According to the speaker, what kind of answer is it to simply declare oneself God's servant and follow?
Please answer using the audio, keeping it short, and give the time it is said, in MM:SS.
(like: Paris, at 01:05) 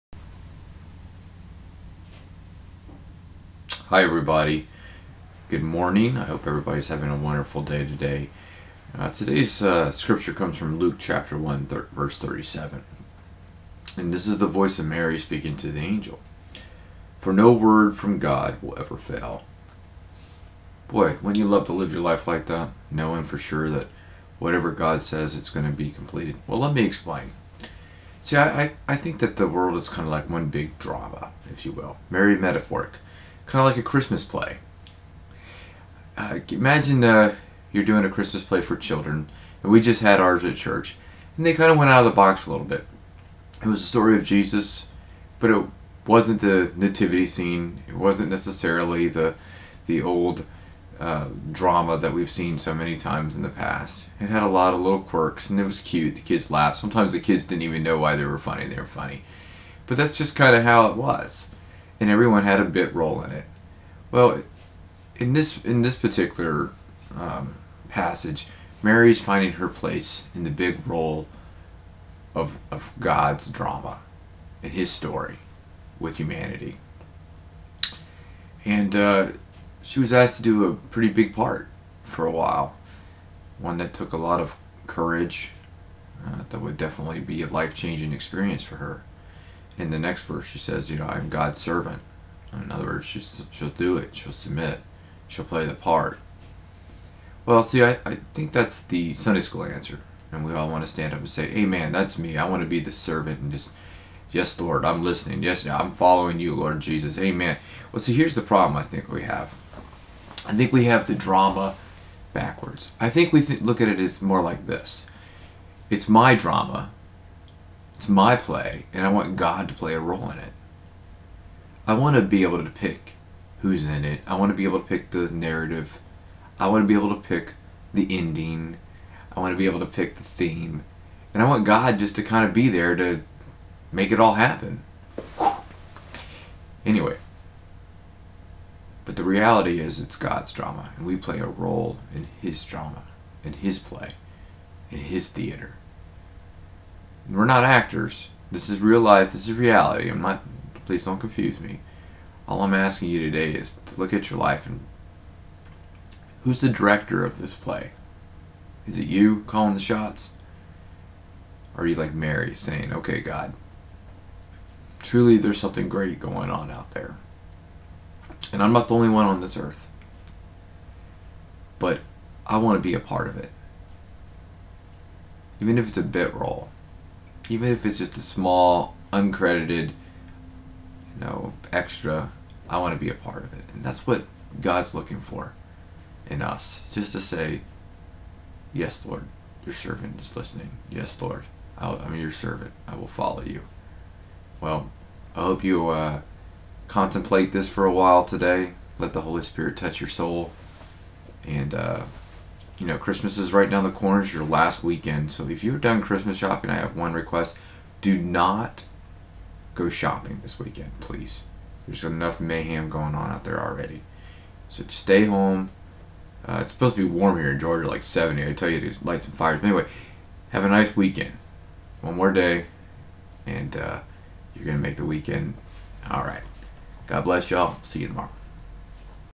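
The Sunday school answer, at 01:39.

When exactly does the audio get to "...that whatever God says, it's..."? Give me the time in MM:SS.
00:23.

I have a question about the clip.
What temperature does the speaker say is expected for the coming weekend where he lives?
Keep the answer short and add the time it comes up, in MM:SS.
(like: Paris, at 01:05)
70, at 03:38.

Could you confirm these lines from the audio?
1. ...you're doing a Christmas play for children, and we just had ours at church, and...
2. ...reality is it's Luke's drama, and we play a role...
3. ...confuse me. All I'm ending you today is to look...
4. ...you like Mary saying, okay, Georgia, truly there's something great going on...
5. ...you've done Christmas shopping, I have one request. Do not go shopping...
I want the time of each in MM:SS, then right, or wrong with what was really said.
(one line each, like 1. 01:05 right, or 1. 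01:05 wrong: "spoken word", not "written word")
1. 00:37 right
2. 02:19 wrong: "God", not "Luke"
3. 02:31 wrong: "asking", not "ending"
4. 02:41 wrong: "God", not "Georgia"
5. 03:25 right.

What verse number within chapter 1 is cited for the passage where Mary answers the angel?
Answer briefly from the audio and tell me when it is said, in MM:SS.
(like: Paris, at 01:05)
37, at 00:11.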